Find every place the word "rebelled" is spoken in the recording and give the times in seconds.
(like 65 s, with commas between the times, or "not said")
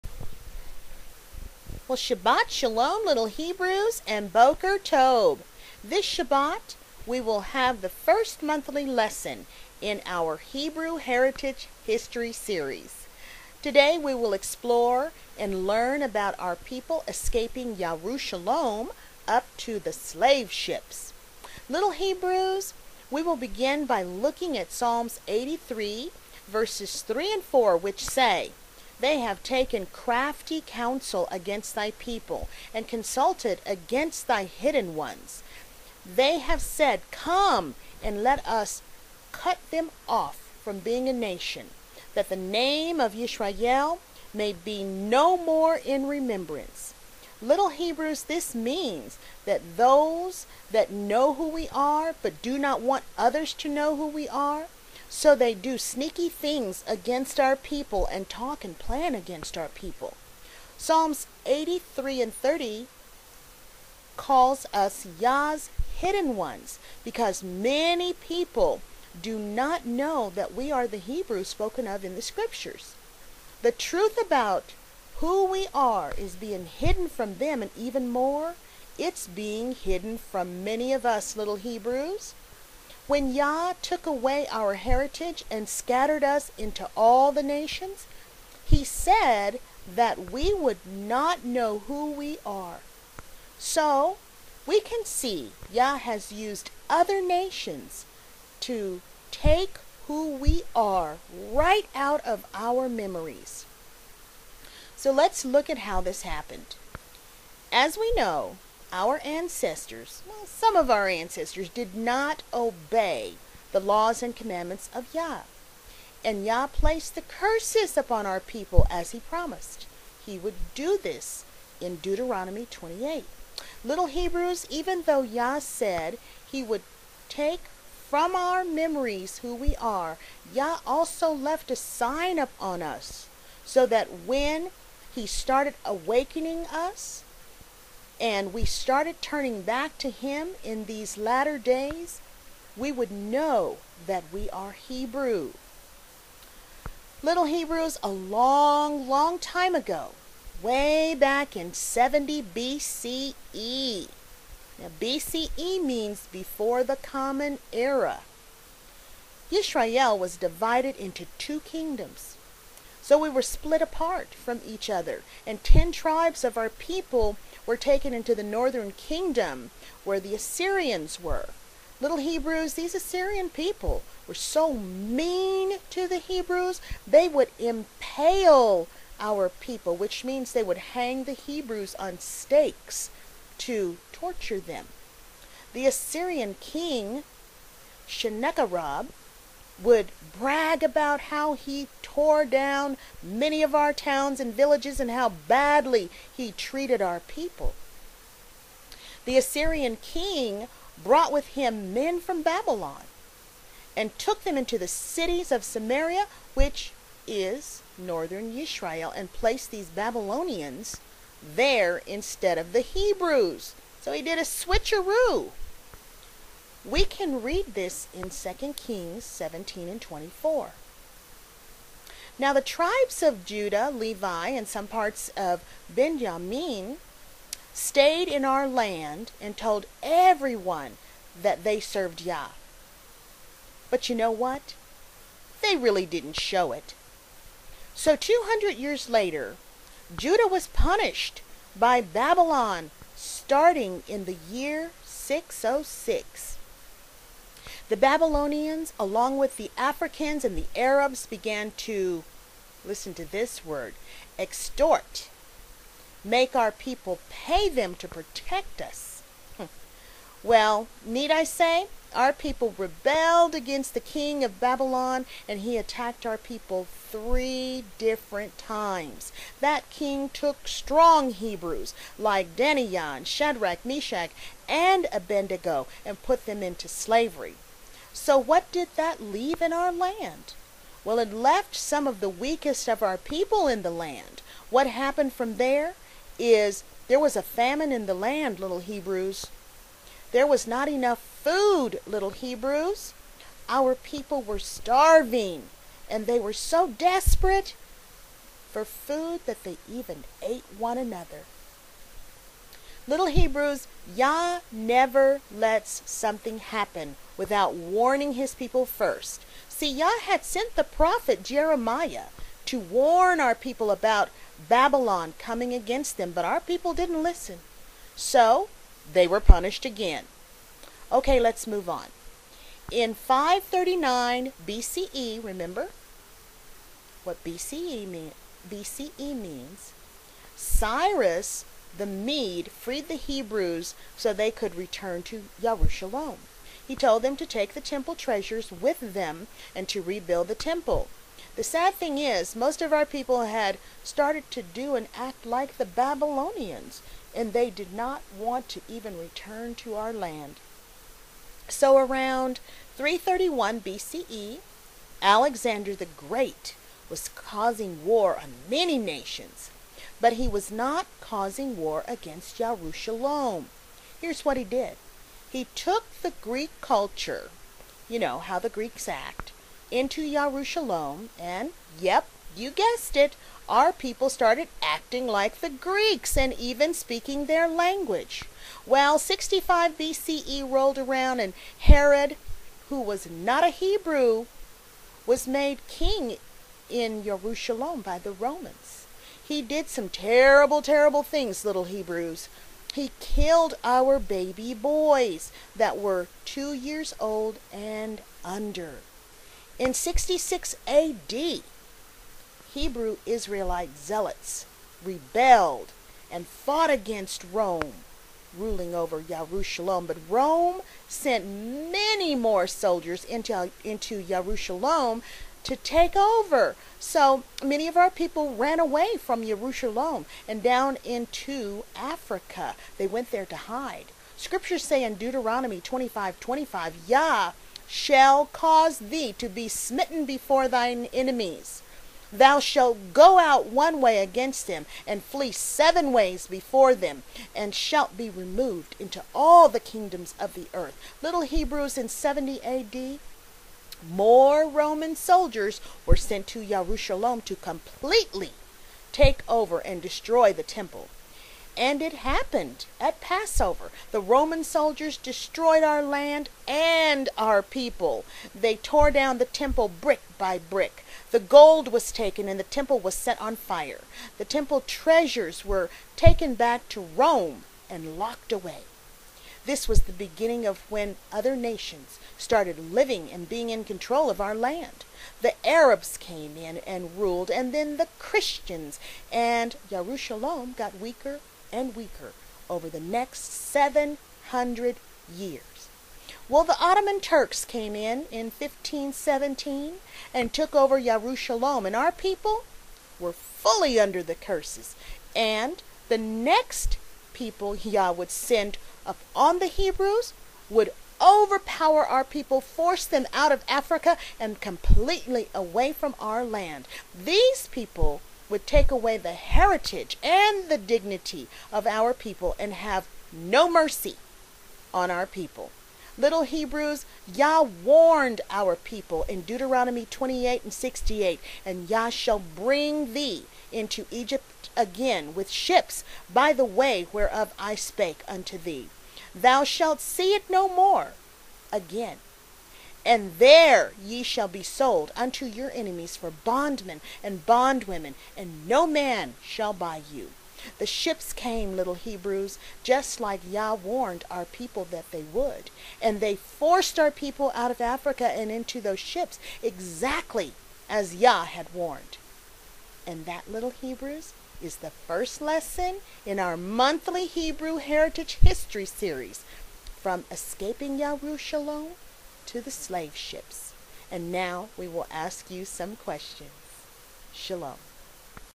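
262 s, 405 s.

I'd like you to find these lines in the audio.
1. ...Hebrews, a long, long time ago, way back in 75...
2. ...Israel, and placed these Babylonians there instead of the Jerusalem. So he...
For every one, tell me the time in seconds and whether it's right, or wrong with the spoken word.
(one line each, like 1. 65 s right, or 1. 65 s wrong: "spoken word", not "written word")
1. 147 s wrong: "70", not "75"
2. 208 s wrong: "Hebrews", not "Jerusalem".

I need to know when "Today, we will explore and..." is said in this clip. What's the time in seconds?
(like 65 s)
13 s.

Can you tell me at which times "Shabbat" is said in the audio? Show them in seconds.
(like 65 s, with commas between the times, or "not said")
1 s, 6 s.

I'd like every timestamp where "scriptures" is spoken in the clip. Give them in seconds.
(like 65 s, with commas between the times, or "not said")
72 s, 424 s.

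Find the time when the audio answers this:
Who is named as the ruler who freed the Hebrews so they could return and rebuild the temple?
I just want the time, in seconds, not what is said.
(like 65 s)
330 s.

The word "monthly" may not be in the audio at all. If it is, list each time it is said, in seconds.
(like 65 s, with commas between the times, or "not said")
8 s, 556 s.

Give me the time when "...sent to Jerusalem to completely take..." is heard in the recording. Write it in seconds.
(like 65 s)
446 s.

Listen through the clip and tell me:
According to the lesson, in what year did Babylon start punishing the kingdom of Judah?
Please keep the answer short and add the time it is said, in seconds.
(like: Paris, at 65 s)
606, at 245 s.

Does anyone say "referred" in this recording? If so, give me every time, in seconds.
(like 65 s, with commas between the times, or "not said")
not said.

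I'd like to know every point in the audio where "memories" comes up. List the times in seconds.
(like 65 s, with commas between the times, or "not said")
102 s, 128 s.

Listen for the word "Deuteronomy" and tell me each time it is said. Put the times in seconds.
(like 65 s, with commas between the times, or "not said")
121 s, 425 s, 519 s.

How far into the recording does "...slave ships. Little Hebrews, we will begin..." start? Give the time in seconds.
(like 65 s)
19 s.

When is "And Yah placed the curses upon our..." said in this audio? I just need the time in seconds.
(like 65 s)
116 s.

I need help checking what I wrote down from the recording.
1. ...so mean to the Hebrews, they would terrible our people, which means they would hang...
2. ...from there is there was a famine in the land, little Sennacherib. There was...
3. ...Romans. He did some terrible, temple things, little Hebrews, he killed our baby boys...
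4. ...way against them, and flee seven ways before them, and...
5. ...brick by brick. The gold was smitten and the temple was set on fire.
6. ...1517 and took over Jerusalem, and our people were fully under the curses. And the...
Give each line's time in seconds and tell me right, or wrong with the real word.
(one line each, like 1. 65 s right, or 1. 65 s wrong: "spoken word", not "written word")
1. 174 s wrong: "impale", not "terrible"
2. 285 s wrong: "Hebrews", not "Sennacherib"
3. 388 s wrong: "terrible", not "temple"
4. 433 s right
5. 460 s wrong: "taken", not "smitten"
6. 488 s right.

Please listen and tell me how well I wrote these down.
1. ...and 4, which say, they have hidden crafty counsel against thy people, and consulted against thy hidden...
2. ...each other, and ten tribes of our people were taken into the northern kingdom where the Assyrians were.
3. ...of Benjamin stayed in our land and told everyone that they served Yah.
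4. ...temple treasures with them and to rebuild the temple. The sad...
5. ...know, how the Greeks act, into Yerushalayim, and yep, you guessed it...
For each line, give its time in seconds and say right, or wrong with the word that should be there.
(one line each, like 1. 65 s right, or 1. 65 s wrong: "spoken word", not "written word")
1. 27 s wrong: "taken", not "hidden"
2. 164 s right
3. 225 s right
4. 337 s right
5. 368 s right.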